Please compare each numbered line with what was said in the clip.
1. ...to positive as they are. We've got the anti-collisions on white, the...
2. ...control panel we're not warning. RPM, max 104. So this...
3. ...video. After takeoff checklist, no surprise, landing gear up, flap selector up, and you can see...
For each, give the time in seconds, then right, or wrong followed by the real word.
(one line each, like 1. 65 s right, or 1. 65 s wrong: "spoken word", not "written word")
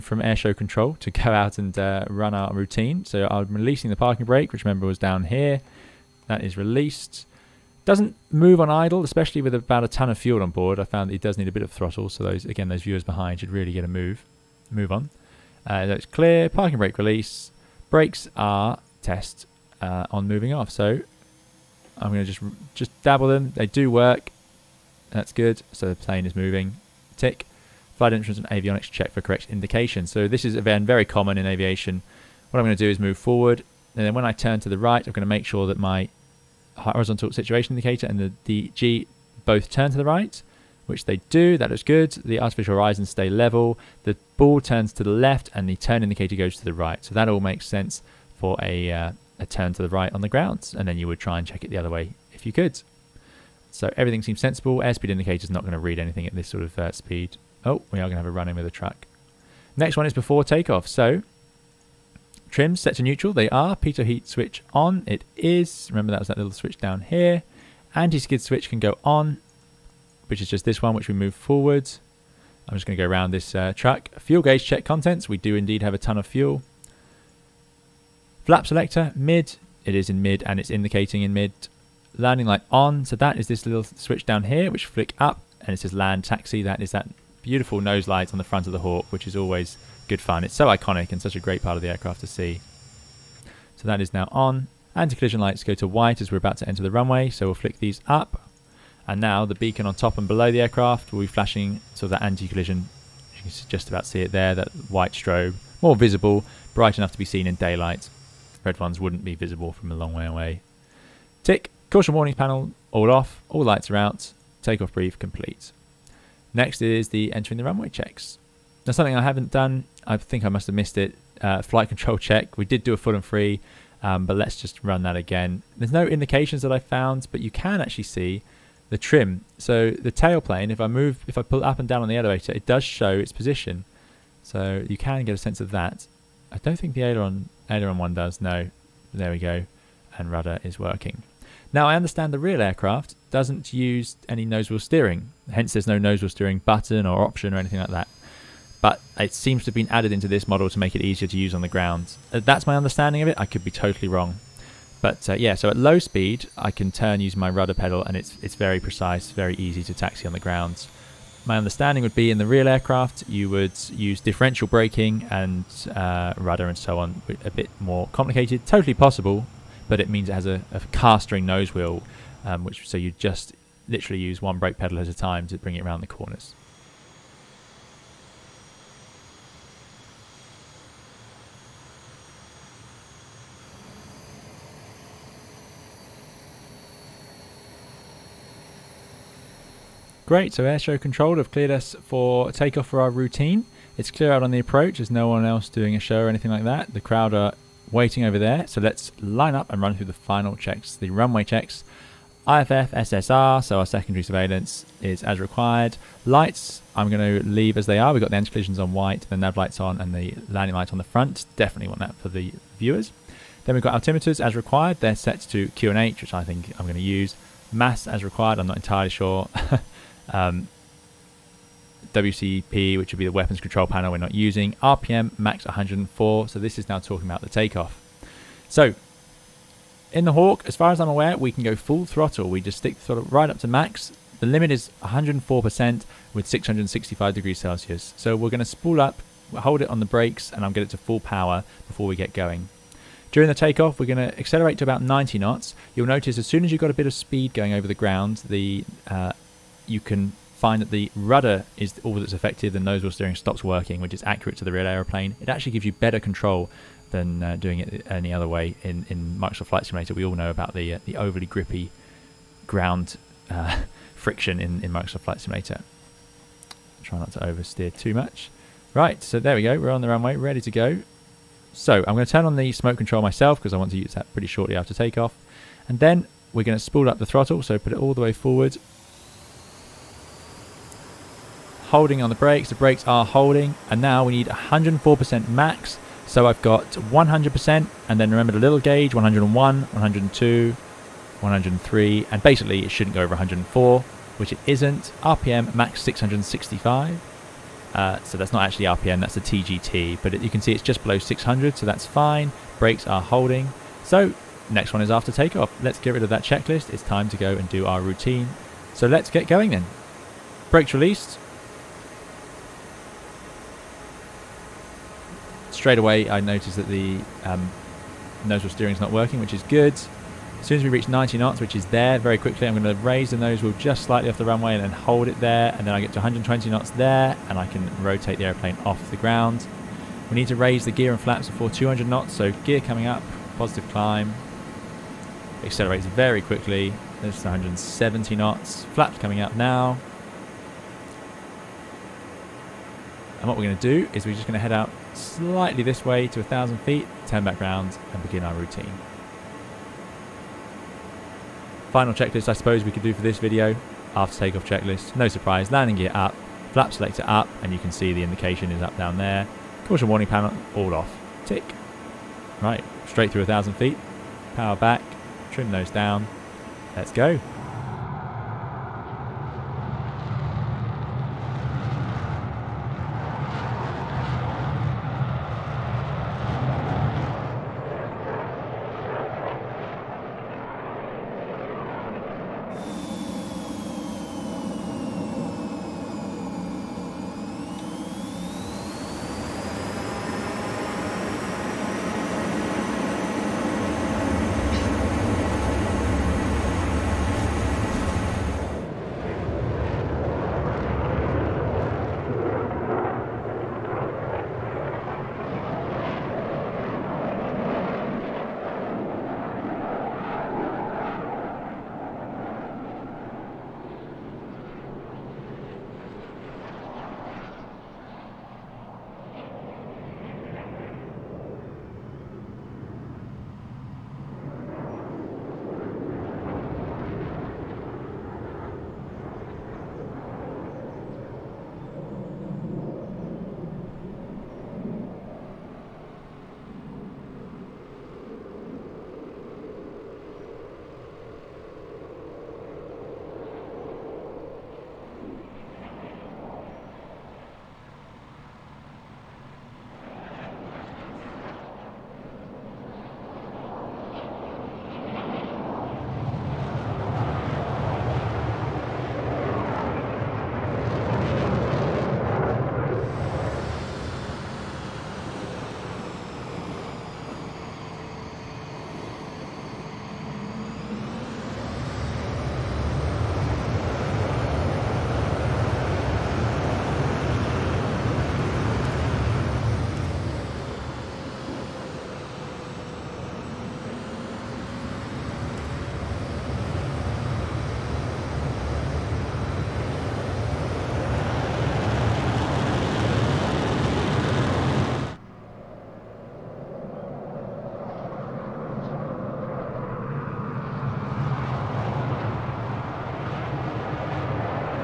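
1. 207 s wrong: "leave", not "positive"
2. 223 s wrong: "using", not "warning"
3. 353 s right.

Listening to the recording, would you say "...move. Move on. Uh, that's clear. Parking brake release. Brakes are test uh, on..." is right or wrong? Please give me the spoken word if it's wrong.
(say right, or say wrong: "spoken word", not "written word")
right.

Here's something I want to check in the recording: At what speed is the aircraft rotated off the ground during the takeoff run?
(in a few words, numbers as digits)
120 knots.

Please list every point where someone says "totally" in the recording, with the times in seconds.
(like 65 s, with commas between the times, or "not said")
153 s, 168 s.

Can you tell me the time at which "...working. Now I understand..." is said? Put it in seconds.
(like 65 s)
140 s.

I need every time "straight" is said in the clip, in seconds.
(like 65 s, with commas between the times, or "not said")
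315 s, 363 s.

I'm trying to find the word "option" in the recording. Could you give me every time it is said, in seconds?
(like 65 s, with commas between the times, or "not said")
147 s.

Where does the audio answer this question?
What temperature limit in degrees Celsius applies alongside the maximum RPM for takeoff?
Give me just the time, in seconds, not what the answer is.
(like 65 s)
236 s.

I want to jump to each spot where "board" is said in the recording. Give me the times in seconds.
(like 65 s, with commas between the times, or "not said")
10 s.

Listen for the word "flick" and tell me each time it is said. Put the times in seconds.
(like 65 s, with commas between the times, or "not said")
84 s, 97 s.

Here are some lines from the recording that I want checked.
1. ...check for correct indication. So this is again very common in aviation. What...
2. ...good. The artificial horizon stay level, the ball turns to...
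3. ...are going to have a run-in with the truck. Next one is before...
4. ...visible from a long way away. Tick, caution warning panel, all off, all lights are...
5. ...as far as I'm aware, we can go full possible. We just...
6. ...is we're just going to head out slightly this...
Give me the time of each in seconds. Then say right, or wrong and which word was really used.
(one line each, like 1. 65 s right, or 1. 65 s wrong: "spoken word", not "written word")
1. 28 s right
2. 41 s right
3. 57 s right
4. 109 s right
5. 230 s wrong: "throttle", not "possible"
6. 344 s right.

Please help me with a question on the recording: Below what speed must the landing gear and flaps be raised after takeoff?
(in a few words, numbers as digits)
200 knots.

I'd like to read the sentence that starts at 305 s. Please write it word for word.
Let's get rid of that checklist.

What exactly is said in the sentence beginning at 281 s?
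Holding on the brakes, the brakes are holding.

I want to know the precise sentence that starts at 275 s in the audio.
And then we're going to spool up the throttle, so put it all the way forward.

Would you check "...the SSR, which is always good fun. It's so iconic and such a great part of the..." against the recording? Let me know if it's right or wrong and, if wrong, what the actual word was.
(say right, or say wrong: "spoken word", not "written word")
wrong: "Hawk", not "SSR".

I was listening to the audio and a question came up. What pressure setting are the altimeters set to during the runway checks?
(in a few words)
QNH.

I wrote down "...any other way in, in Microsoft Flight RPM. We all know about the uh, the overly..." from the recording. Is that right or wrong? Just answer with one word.
wrong.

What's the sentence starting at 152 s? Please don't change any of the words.
Uh, that's my understanding of it.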